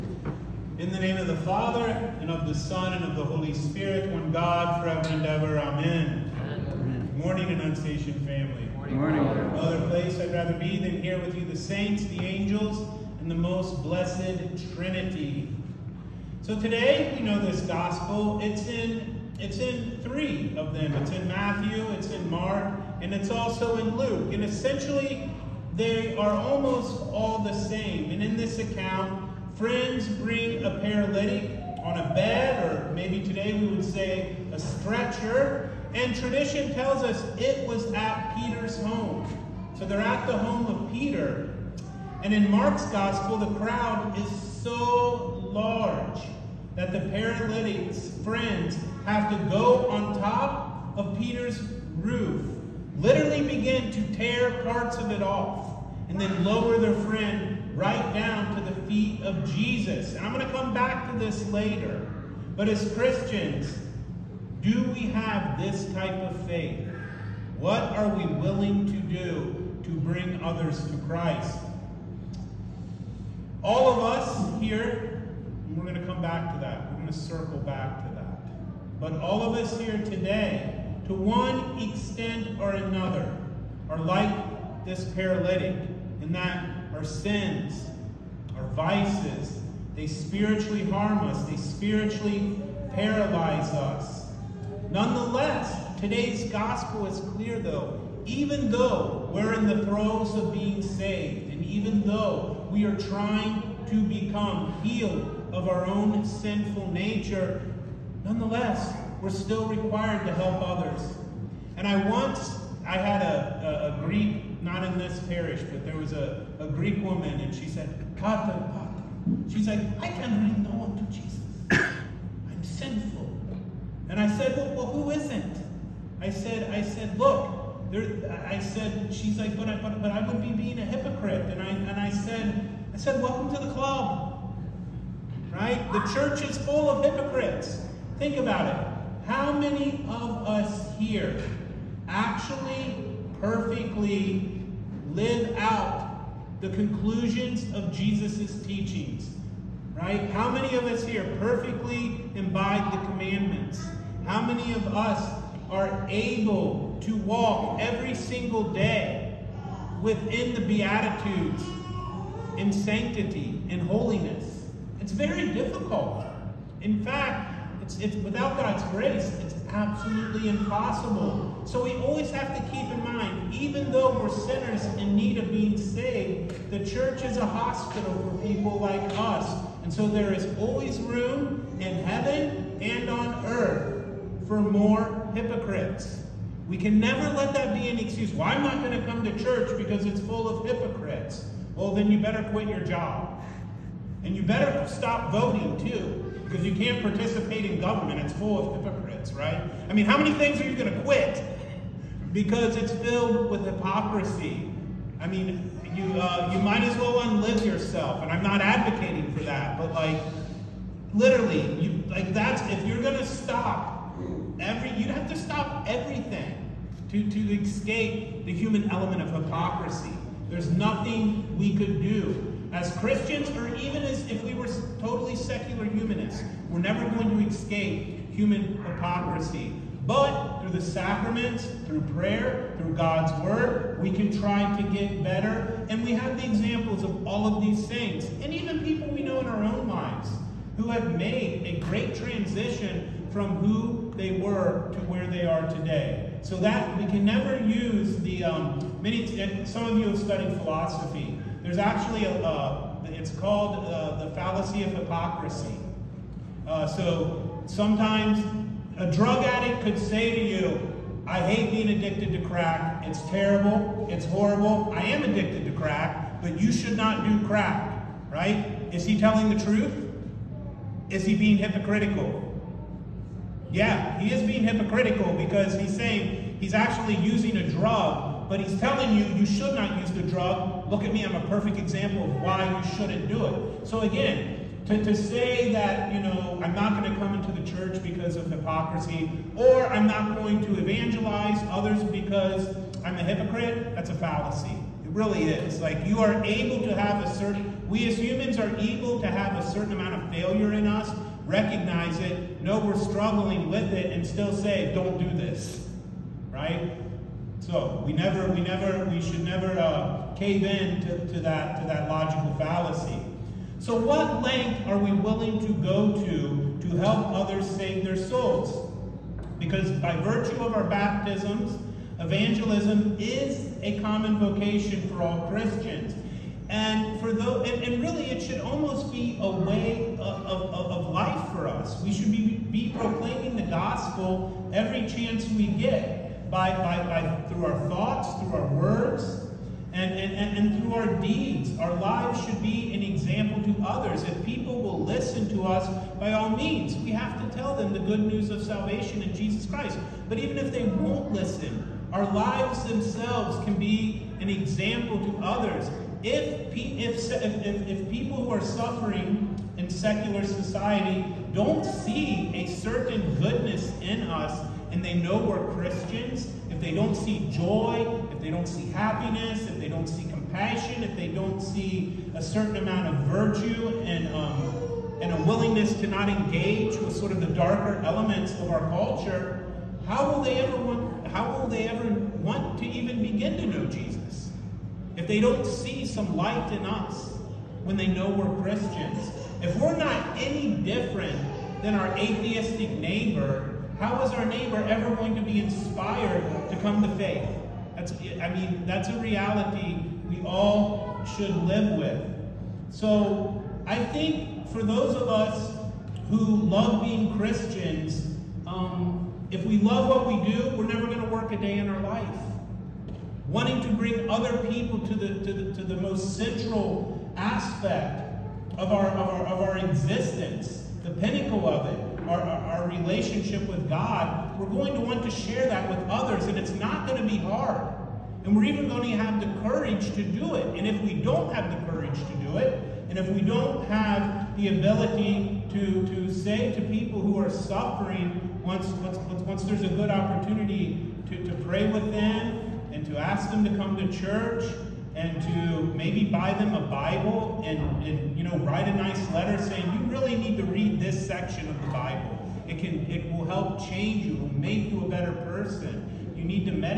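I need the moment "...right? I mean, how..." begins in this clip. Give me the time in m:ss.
3:19.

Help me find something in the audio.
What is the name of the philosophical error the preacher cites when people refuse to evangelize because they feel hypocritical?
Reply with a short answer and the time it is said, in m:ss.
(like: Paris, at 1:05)
fallacy of hypocrisy, at 4:14.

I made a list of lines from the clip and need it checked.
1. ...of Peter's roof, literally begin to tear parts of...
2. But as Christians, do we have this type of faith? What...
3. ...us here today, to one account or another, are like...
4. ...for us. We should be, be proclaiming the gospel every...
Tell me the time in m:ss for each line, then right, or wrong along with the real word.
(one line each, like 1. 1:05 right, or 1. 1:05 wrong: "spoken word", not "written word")
1. 0:50 right
2. 1:02 right
3. 1:19 wrong: "extent", not "account"
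4. 5:31 right.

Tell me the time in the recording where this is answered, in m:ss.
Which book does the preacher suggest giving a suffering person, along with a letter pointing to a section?
7:26.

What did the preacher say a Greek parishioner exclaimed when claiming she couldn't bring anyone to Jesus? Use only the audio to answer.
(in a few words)
Kata Pata.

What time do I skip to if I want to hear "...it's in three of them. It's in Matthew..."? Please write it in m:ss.
0:19.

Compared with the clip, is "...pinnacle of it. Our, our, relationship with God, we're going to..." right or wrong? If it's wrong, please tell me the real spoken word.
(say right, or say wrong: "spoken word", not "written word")
right.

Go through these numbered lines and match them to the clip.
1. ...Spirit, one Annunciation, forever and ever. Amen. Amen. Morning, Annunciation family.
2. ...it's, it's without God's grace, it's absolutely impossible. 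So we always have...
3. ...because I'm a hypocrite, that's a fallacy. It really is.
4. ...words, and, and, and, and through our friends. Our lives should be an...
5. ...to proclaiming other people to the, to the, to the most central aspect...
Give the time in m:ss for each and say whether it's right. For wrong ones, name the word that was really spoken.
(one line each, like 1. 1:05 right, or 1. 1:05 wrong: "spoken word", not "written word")
1. 0:03 wrong: "God", not "Annunciation"
2. 2:47 right
3. 4:52 right
4. 5:38 wrong: "deeds", not "friends"
5. 6:53 wrong: "bring", not "proclaiming".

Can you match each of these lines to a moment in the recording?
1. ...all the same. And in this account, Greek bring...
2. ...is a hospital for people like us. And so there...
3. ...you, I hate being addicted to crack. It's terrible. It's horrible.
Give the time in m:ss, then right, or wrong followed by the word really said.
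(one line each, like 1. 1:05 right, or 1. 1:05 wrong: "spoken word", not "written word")
1. 0:27 wrong: "Friends", not "Greek"
2. 2:57 right
3. 4:20 right.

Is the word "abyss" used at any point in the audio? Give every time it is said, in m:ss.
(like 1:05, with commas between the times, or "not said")
not said.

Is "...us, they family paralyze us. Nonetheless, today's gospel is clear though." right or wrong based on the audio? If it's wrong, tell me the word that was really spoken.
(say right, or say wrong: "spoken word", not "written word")
wrong: "spiritually", not "family".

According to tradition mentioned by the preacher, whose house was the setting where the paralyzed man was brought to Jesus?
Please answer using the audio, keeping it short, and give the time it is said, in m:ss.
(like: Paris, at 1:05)
Peter's home, at 0:38.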